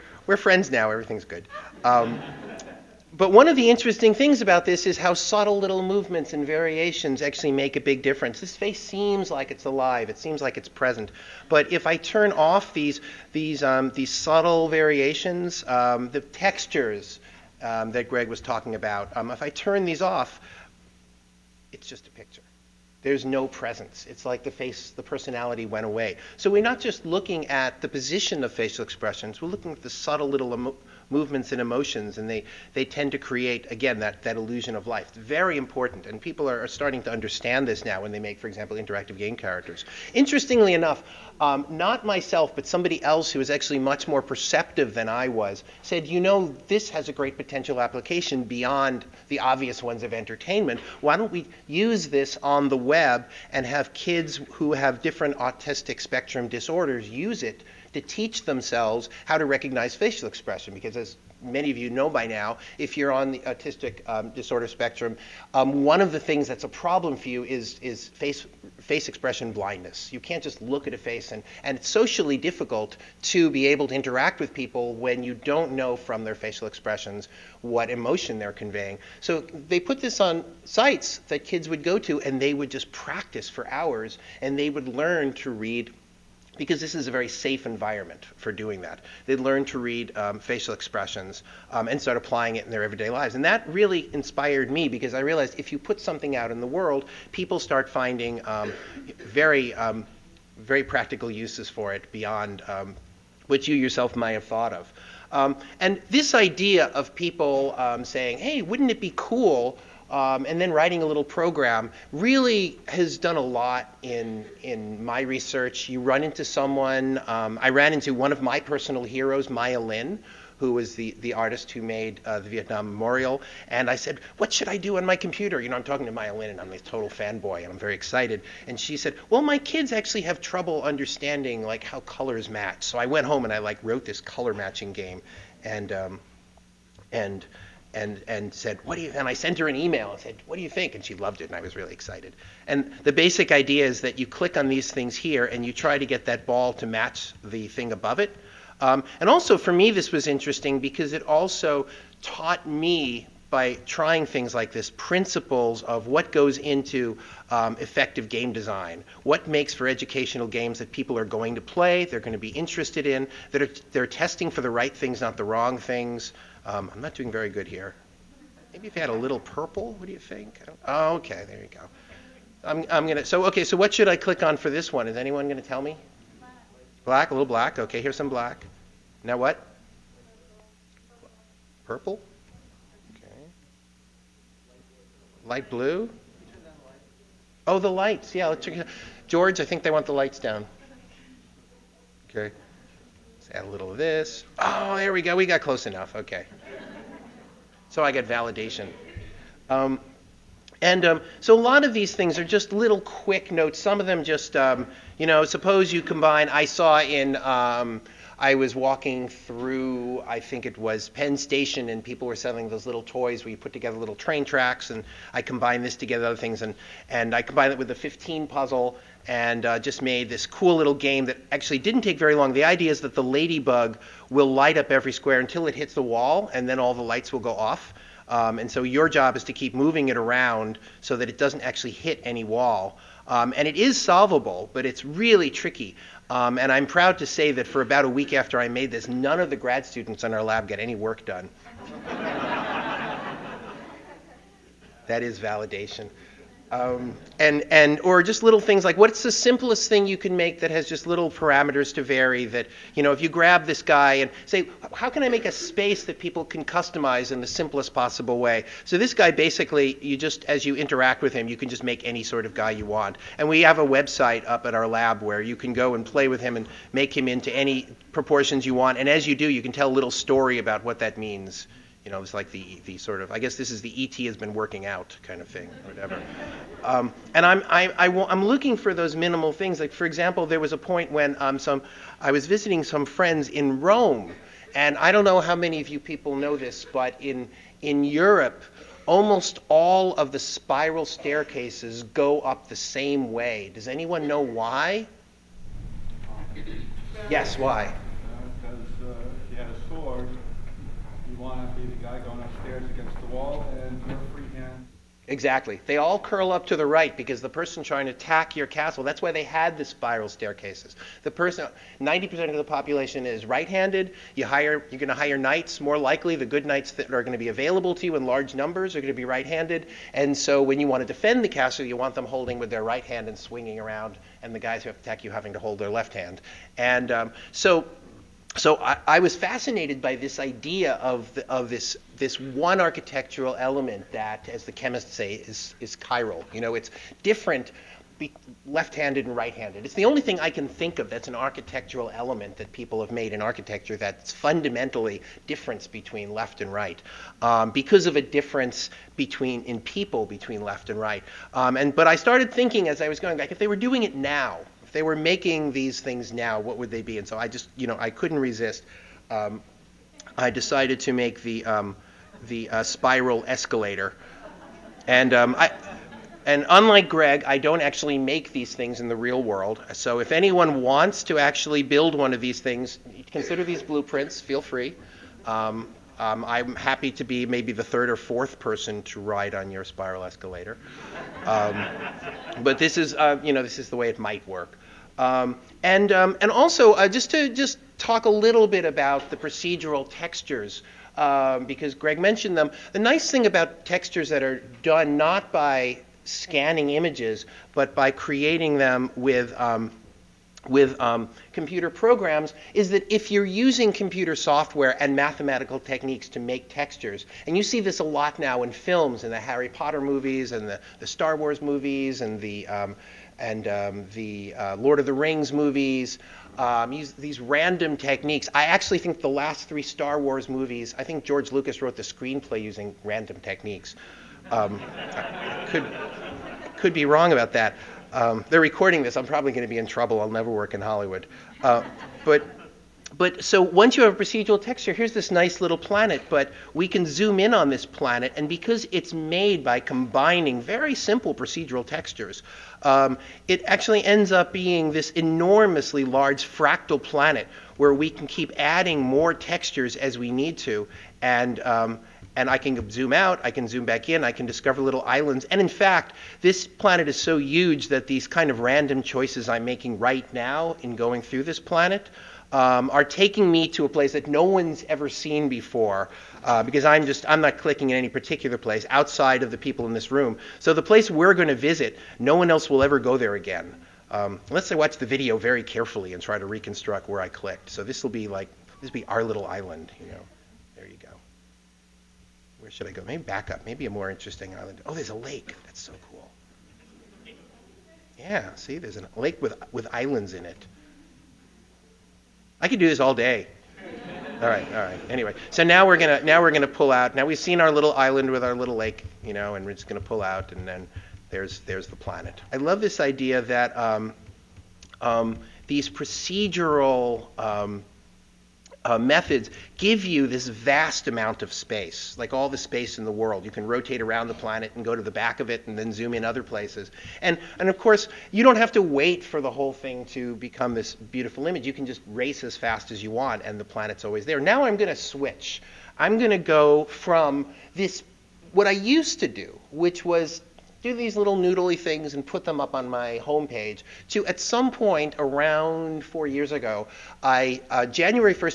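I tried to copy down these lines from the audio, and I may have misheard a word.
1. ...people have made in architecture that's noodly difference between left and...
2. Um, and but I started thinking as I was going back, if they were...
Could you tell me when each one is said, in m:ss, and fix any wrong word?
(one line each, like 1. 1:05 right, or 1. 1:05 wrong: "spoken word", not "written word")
1. 5:42 wrong: "fundamentally", not "noodly"
2. 5:51 right.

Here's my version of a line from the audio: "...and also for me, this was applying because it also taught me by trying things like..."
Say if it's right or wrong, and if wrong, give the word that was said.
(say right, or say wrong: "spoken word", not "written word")
wrong: "interesting", not "applying".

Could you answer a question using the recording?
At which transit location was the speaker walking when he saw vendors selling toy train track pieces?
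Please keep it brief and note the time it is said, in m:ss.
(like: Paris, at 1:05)
Penn Station, at 3:31.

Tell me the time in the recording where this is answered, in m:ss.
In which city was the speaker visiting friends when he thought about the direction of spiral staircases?
4:43.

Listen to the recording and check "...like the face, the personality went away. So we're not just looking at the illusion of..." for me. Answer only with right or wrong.
wrong.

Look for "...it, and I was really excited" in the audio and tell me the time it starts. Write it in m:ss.
2:21.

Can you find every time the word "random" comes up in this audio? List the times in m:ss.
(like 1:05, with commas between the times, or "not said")
6:57, 7:03, 7:38.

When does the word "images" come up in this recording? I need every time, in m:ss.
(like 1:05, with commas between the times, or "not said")
6:36, 8:41.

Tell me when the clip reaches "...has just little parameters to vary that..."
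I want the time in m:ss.
4:10.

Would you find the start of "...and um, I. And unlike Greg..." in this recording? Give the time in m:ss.
6:05.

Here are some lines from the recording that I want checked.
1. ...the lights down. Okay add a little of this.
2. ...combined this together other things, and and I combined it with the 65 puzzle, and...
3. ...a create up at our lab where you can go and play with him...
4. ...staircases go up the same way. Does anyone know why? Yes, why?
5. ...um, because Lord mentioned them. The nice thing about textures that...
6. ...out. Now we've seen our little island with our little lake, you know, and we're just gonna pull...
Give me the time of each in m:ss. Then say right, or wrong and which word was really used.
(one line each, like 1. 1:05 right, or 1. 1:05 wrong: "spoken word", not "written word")
1. 3:10 right
2. 3:35 wrong: "15", not "65"
3. 4:23 wrong: "website", not "create"
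4. 4:51 right
5. 6:31 wrong: "Greg", not "Lord"
6. 8:16 right.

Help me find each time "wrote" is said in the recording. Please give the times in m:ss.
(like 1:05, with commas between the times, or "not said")
2:13, 7:01.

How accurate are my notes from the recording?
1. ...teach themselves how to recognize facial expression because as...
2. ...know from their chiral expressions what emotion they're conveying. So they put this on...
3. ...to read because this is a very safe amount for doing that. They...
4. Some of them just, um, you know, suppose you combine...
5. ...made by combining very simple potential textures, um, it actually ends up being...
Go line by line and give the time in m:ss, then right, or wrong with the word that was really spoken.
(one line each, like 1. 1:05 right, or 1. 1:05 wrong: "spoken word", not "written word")
1. 0:58 right
2. 1:15 wrong: "facial", not "chiral"
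3. 1:25 wrong: "environment", not "amount"
4. 3:23 right
5. 7:19 wrong: "procedural", not "potential".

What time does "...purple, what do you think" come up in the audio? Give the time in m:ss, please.
2:49.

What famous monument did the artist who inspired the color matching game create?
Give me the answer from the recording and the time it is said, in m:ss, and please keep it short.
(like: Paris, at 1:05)
Vietnam Memorial, at 2:02.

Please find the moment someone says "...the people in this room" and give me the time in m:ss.
7:49.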